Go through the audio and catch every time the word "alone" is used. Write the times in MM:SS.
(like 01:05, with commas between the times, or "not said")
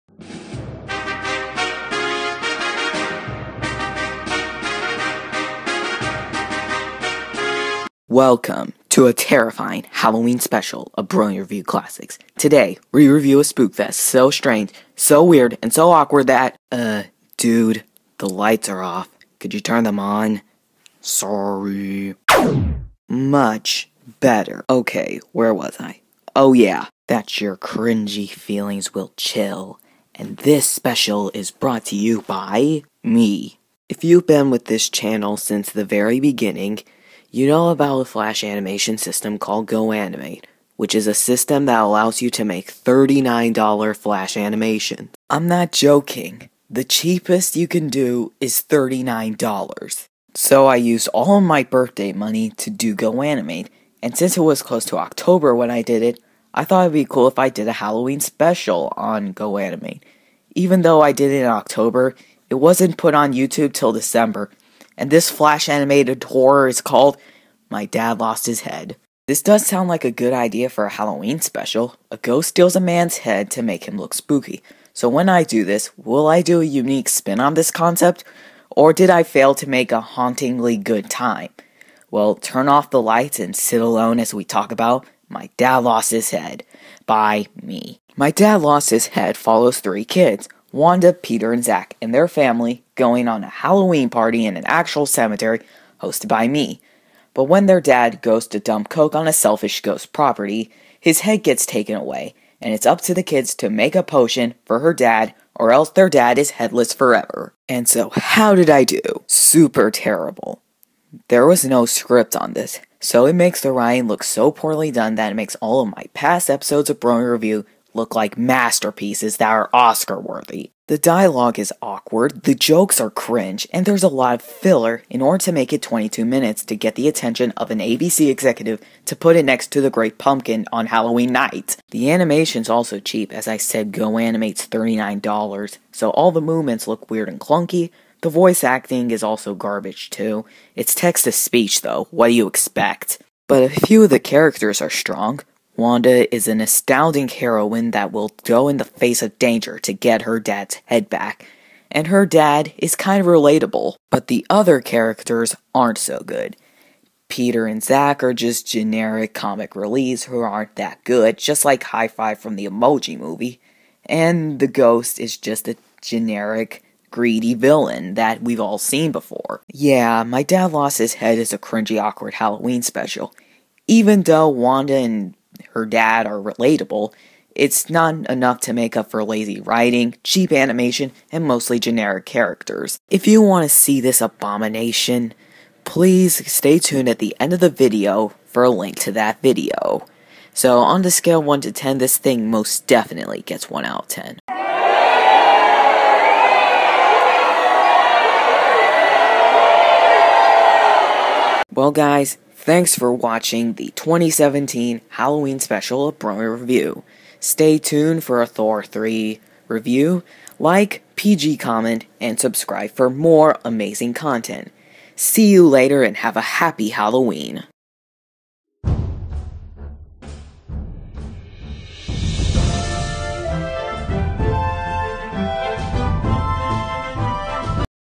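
01:23.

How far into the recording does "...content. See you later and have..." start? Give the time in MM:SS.
03:34.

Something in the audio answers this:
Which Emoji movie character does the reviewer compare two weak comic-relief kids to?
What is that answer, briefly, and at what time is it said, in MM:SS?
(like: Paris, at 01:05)
High Five, at 02:41.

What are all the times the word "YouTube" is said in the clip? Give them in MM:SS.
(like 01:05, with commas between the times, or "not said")
01:03.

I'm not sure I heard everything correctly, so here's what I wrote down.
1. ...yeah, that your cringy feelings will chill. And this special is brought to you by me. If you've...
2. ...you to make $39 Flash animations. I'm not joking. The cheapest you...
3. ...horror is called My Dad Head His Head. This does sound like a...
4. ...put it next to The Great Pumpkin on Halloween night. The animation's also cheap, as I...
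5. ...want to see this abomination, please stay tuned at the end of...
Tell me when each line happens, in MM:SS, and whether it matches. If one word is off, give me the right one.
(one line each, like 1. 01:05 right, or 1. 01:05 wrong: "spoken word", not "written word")
1. 00:26 right
2. 00:42 right
3. 01:06 wrong: "Lost", not "Head"
4. 02:09 right
5. 03:03 right.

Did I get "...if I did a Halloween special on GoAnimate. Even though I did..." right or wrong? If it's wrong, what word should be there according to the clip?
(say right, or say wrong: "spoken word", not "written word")
right.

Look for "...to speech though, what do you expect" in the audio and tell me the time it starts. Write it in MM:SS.
02:21.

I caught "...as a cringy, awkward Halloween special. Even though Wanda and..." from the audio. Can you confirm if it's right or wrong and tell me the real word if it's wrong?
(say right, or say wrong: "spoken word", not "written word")
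right.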